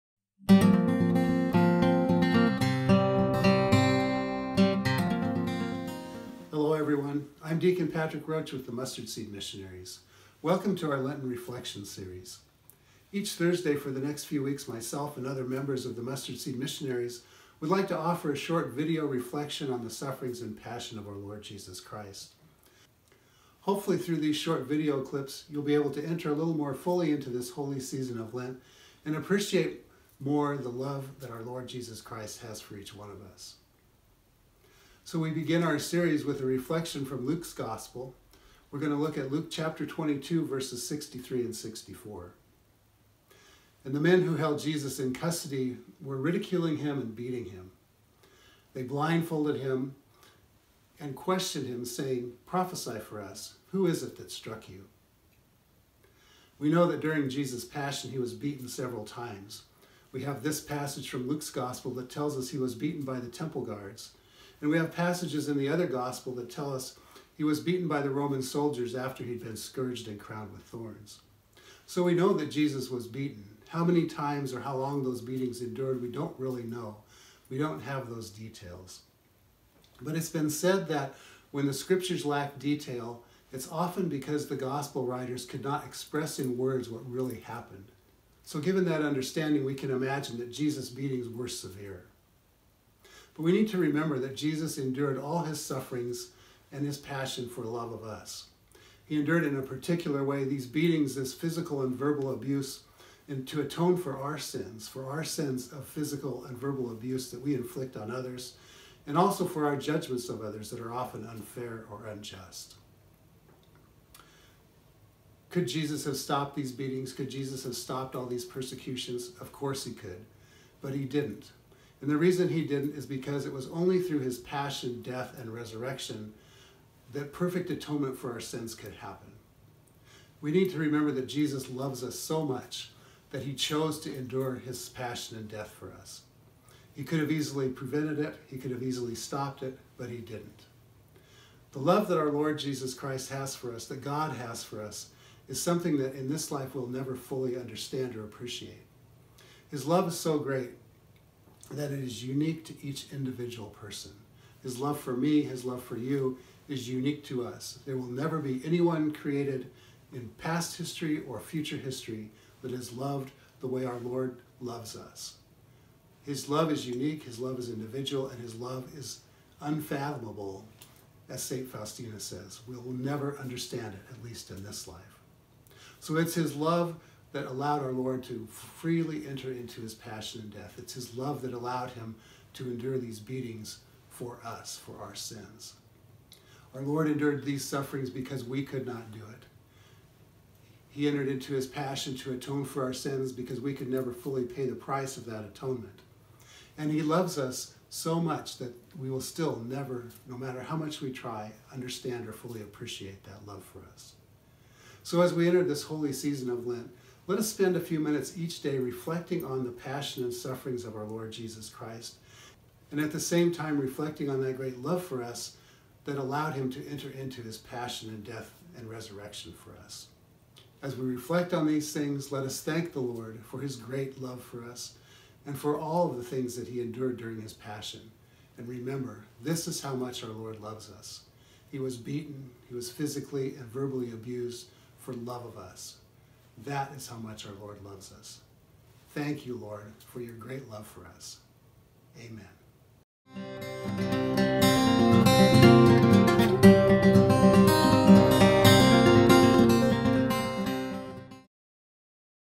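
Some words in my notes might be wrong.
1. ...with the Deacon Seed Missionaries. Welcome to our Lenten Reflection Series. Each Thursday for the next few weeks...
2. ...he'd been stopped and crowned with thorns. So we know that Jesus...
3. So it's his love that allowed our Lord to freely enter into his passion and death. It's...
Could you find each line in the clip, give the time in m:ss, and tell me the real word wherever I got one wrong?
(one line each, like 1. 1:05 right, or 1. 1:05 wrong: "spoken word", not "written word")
1. 0:08 wrong: "Mustard", not "Deacon"
2. 1:09 wrong: "scourged", not "stopped"
3. 2:55 right.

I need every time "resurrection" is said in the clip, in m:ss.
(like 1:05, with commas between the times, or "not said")
2:05, 3:38.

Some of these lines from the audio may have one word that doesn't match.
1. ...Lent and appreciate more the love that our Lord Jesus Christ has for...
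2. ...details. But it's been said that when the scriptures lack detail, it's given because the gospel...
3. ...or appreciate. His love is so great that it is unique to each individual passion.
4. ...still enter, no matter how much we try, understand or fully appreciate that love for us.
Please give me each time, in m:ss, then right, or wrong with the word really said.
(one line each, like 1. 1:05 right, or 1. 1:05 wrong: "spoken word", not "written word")
1. 0:28 right
2. 1:18 wrong: "often", not "given"
3. 2:28 wrong: "person", not "passion"
4. 3:19 wrong: "never", not "enter".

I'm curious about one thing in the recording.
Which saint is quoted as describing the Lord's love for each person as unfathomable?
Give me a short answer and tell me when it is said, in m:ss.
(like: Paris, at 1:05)
St. Faustina, at 2:51.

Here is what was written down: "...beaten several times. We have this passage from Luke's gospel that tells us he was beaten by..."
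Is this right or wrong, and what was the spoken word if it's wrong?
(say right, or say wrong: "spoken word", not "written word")
right.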